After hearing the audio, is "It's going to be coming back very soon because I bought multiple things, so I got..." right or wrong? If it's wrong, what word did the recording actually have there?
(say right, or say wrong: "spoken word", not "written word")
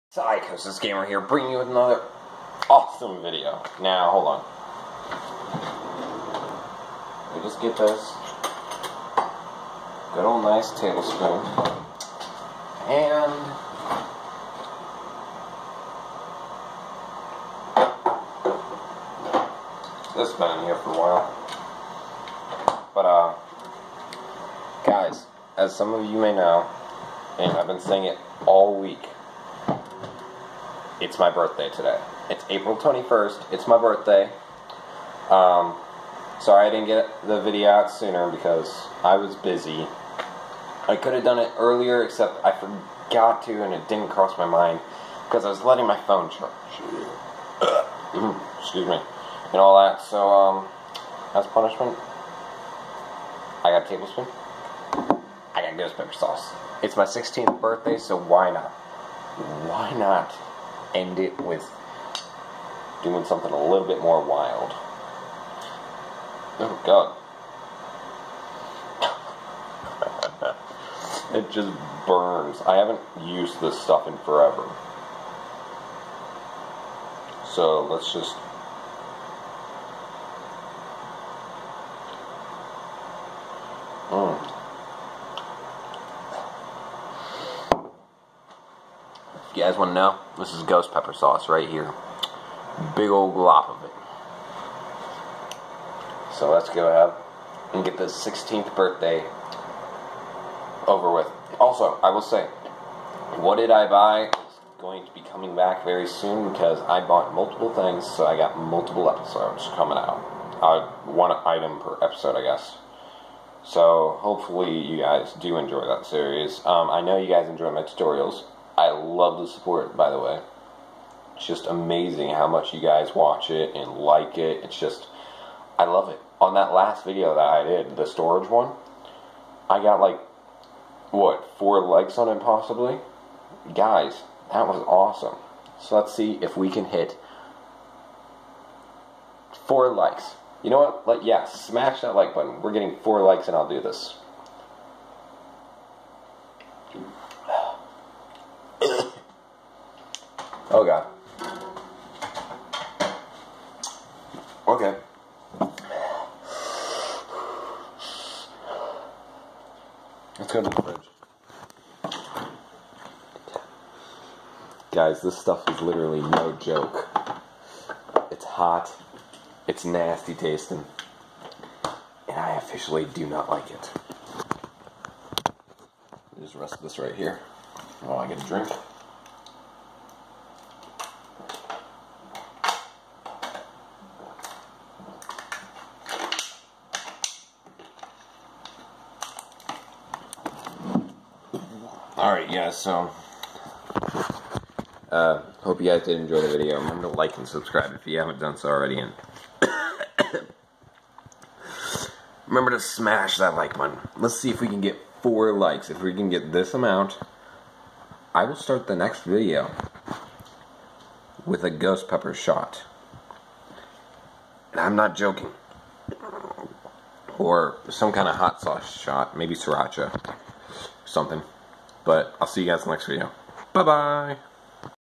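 right.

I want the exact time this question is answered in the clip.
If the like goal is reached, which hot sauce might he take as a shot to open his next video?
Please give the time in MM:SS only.
03:39.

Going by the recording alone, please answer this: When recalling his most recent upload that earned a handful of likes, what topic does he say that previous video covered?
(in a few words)
Storage.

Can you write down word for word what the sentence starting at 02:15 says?
So let's see if we can hit four likes.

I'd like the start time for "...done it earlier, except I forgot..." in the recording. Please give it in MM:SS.
00:41.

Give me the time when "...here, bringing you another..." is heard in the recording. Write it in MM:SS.
00:01.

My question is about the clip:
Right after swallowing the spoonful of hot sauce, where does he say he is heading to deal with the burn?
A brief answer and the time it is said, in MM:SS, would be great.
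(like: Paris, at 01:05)
The fridge, at 02:40.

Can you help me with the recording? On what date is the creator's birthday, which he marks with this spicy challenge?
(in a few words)
April 21st.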